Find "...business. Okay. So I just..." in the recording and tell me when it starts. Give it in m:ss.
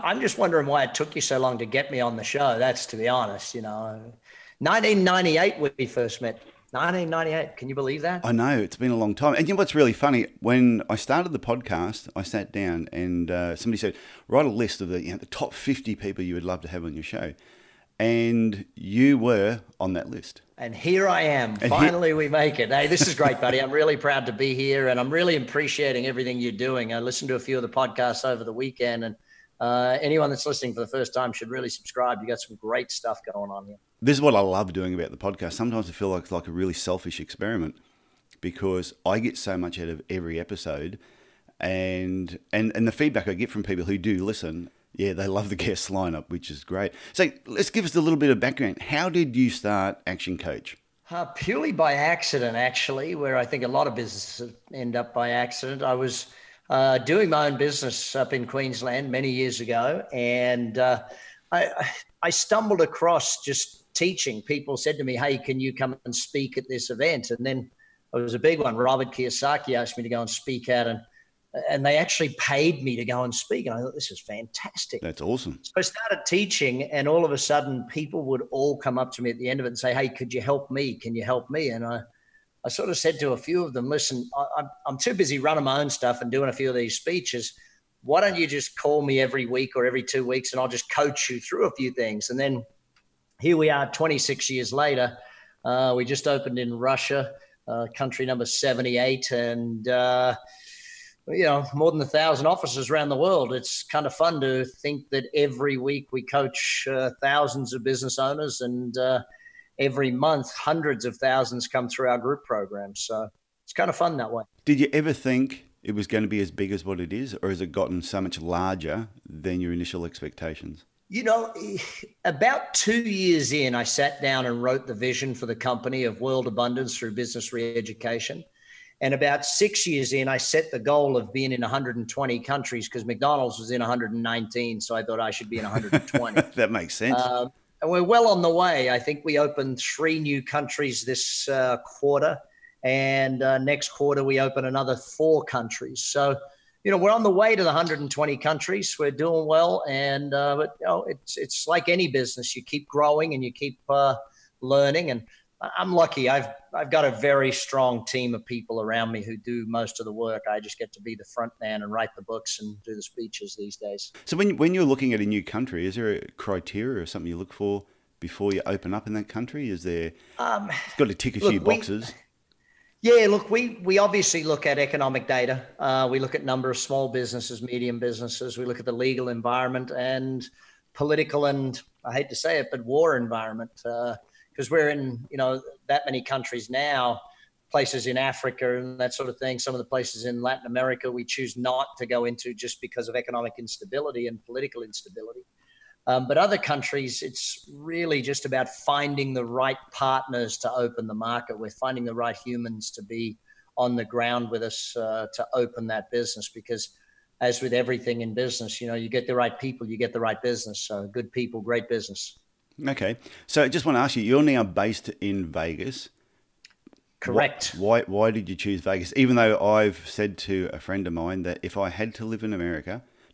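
3:31.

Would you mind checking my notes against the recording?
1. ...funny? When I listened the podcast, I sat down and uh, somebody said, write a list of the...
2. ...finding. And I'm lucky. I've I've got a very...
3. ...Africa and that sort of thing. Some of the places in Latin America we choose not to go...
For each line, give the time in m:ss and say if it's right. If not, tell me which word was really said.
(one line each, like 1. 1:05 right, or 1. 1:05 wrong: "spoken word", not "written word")
1. 0:09 wrong: "started", not "listened"
2. 2:34 wrong: "learning", not "finding"
3. 3:08 right.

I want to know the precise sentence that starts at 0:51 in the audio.
Uh, purely by accident, actually, where I think a lot of businesses end up by accident.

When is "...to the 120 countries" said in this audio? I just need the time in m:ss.
2:27.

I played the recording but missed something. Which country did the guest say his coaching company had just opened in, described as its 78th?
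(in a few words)
Russia.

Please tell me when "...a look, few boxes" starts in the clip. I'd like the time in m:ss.
2:51.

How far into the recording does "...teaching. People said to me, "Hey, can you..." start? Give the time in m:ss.
1:03.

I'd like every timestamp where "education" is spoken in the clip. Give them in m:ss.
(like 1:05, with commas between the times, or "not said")
2:07.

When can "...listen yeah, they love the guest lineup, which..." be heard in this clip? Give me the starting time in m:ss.
0:44.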